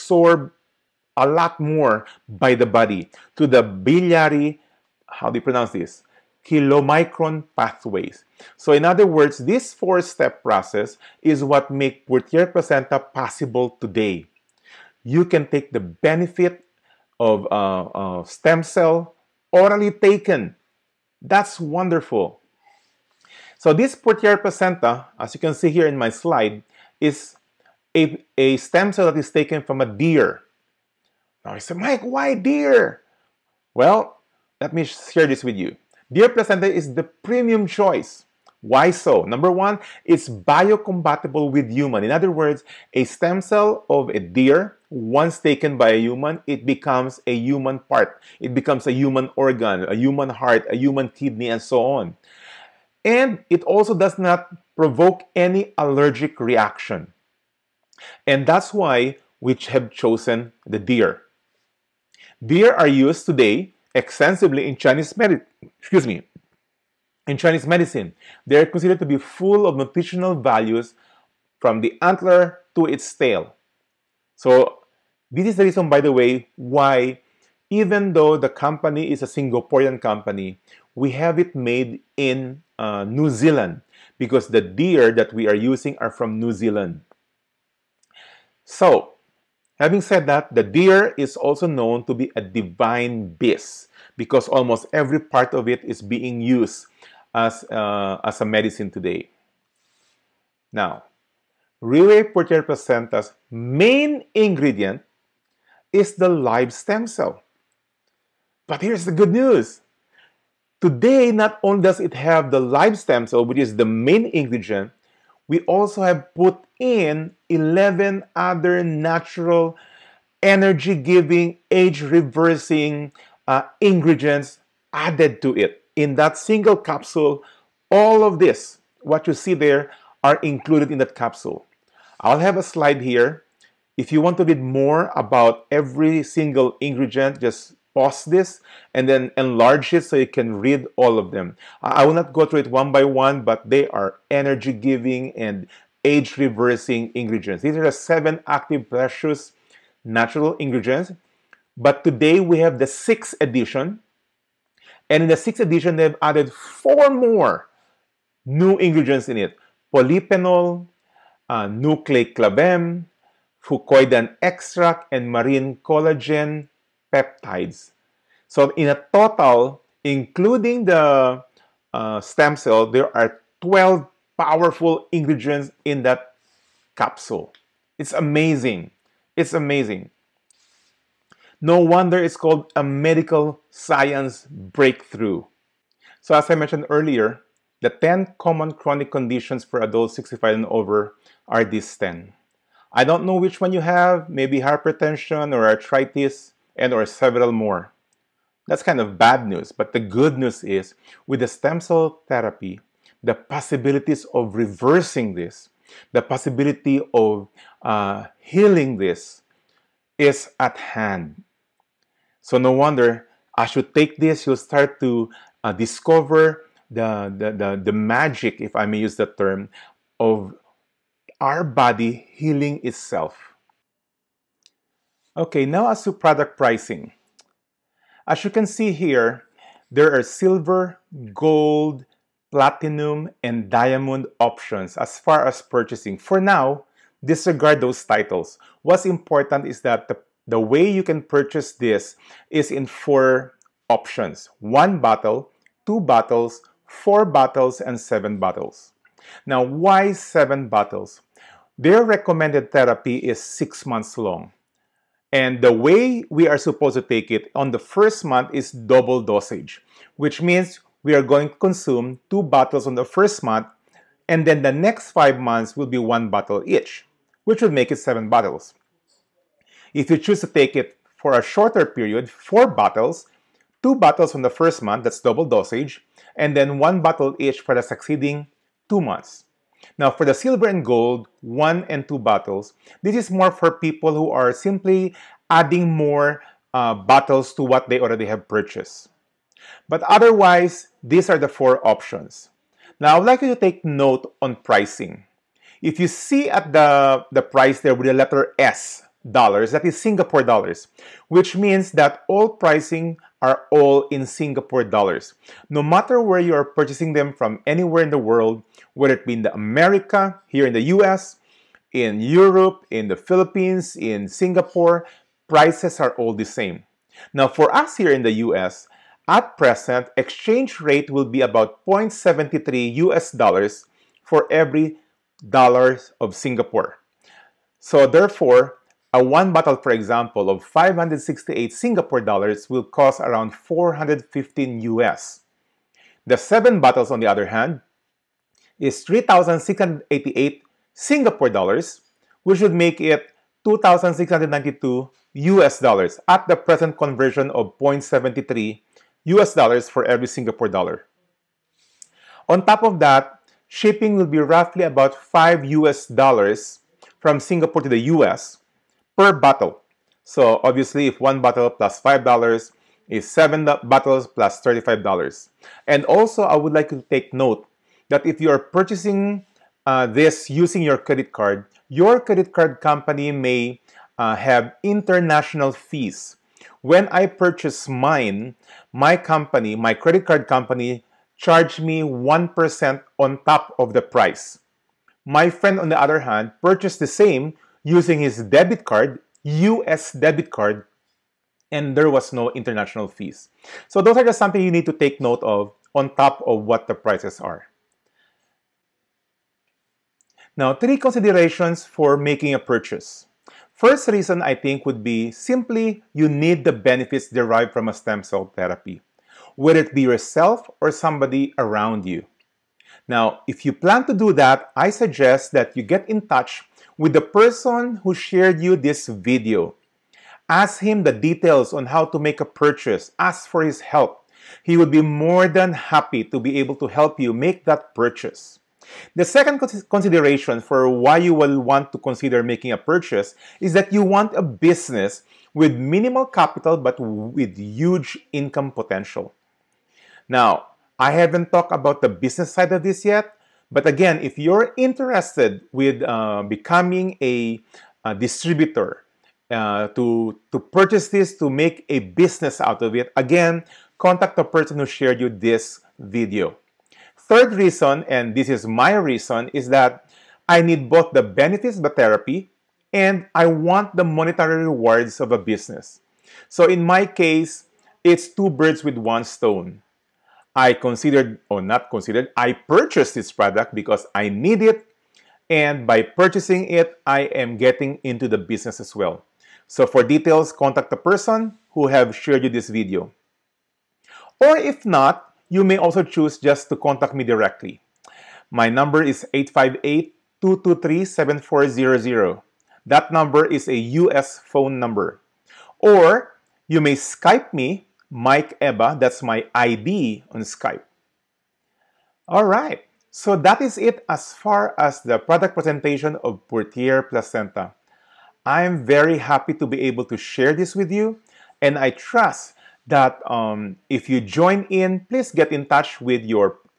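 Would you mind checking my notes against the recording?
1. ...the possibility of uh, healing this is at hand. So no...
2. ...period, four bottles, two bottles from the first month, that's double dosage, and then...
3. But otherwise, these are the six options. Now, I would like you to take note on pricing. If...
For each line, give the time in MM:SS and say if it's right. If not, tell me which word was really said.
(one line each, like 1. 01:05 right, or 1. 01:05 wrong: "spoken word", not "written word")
1. 03:26 right
2. 04:31 right
3. 04:49 wrong: "four", not "six".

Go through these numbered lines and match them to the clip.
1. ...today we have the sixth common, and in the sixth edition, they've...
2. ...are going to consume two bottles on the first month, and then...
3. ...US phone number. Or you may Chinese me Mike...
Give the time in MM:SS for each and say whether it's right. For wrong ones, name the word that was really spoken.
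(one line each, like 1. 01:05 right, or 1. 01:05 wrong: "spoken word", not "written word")
1. 02:32 wrong: "edition", not "common"
2. 04:21 right
3. 08:14 wrong: "Skype", not "Chinese".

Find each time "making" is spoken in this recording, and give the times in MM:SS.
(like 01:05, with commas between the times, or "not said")
06:42, 07:12.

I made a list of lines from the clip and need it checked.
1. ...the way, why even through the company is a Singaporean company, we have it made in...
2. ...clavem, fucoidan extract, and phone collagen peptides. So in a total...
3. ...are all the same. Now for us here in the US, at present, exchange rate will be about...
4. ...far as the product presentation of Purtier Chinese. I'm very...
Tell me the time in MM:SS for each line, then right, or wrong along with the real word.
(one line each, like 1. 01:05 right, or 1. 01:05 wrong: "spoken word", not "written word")
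1. 01:16 wrong: "though", not "through"
2. 02:42 wrong: "marine", not "phone"
3. 05:16 right
4. 08:24 wrong: "Placenta", not "Chinese".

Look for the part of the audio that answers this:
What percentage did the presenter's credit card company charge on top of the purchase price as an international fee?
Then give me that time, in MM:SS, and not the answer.
06:22.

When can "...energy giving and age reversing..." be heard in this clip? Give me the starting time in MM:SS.
02:24.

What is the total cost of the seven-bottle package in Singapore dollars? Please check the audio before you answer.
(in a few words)
3,688.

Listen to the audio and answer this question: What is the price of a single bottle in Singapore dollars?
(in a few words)
568.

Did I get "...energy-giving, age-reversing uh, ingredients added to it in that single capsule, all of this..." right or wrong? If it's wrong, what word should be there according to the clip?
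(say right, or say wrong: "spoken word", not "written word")
right.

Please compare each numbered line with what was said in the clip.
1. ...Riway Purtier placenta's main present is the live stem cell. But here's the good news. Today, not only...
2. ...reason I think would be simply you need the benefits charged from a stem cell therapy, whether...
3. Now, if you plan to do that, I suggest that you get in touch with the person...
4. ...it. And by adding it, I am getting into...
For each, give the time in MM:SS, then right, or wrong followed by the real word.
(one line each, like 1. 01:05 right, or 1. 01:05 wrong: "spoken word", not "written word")
1. 01:41 wrong: "ingredient", not "present"
2. 06:44 wrong: "derived", not "charged"
3. 06:53 right
4. 07:54 wrong: "purchasing", not "adding".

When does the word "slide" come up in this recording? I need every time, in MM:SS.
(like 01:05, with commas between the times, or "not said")
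00:26, 02:12.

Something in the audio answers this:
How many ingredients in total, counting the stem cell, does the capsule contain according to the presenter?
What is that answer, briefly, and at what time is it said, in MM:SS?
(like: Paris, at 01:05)
12, at 02:53.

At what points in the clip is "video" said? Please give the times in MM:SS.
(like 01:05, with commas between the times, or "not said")
06:59, 07:35, 08:02.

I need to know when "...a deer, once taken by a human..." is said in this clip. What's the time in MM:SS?
00:44.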